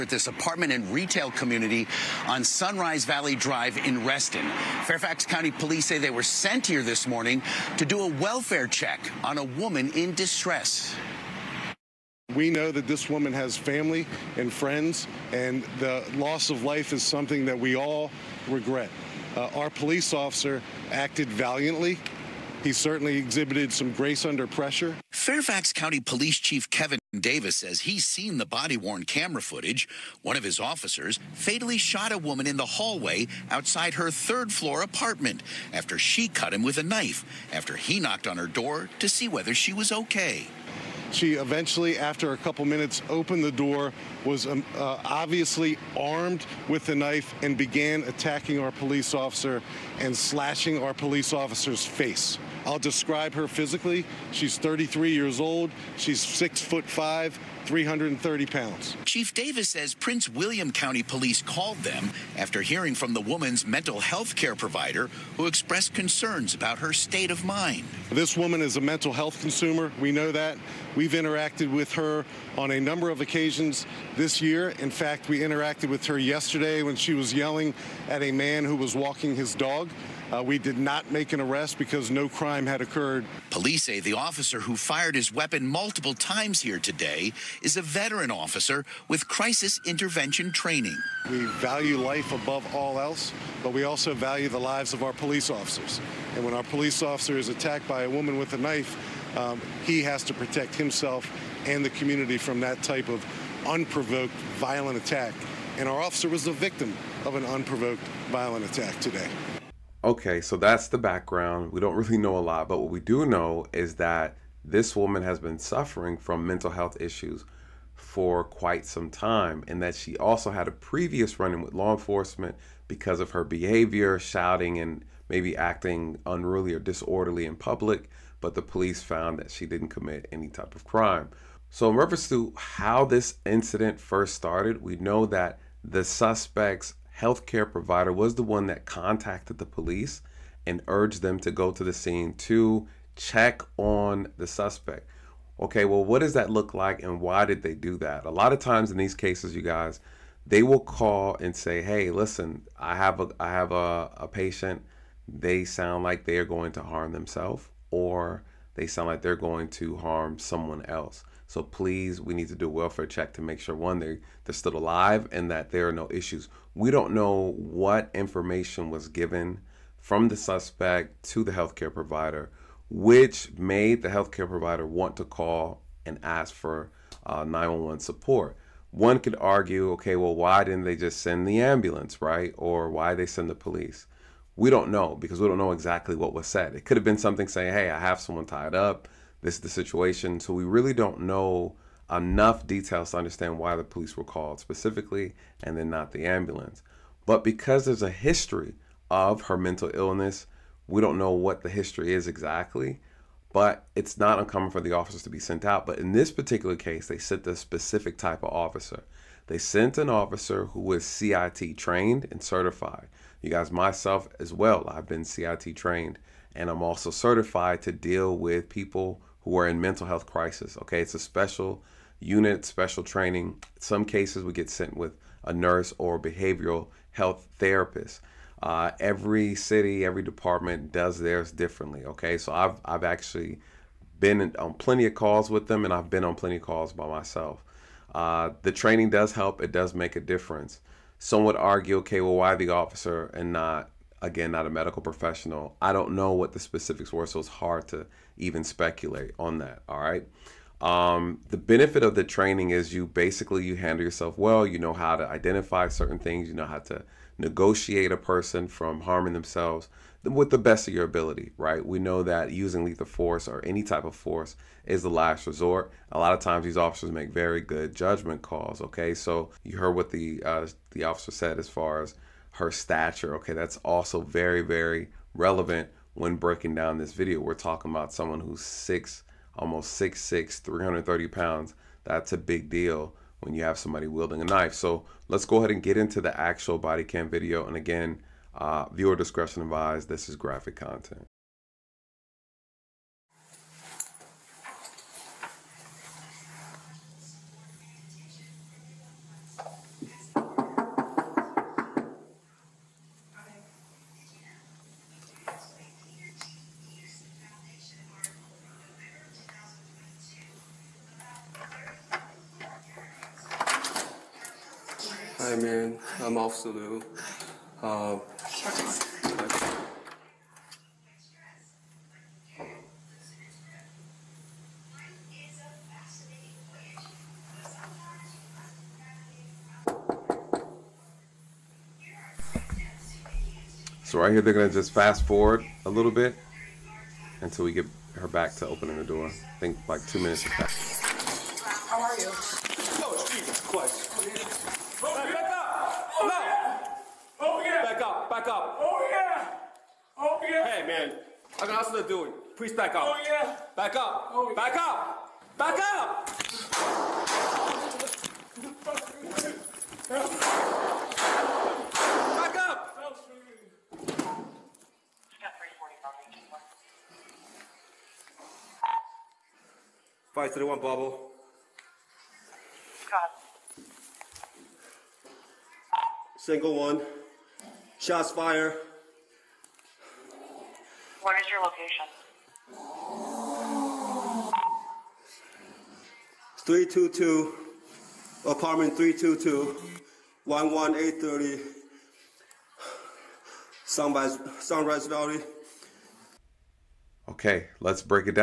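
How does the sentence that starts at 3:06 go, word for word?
It could have been something saying, hey, I have someone tied up.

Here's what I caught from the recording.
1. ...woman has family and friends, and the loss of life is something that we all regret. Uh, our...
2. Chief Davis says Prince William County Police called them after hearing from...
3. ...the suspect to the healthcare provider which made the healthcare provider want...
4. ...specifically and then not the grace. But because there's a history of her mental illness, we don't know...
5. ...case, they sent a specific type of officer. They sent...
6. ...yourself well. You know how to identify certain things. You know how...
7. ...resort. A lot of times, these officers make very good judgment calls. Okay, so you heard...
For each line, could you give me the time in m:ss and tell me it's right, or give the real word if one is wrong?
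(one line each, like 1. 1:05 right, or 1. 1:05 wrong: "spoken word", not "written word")
1. 0:13 right
2. 0:59 right
3. 2:50 right
4. 3:14 wrong: "ambulance", not "grace"
5. 3:26 right
6. 4:14 right
7. 4:25 right.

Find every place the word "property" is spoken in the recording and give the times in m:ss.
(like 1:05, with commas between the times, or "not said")
not said.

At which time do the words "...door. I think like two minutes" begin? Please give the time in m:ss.
5:39.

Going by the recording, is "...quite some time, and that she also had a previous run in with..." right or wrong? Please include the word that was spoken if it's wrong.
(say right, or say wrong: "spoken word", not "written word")
right.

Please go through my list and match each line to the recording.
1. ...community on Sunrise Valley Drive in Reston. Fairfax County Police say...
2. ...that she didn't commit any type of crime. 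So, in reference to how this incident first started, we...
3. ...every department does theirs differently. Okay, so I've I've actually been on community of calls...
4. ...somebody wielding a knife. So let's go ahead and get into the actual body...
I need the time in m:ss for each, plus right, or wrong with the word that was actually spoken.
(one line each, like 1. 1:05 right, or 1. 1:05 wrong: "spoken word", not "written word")
1. 0:01 right
2. 2:09 right
3. 3:50 wrong: "plenty", not "community"
4. 4:43 right.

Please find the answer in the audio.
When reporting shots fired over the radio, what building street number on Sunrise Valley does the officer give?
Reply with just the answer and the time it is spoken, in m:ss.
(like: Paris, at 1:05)
11830, at 6:30.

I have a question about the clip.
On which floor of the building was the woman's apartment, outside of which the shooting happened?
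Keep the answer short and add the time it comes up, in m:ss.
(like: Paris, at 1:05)
Third floor, at 0:34.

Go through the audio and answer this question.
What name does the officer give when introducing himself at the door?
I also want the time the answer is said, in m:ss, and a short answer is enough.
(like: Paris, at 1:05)
Officer Liu, at 5:16.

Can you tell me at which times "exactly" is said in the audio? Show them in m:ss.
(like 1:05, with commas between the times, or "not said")
3:05, 3:22.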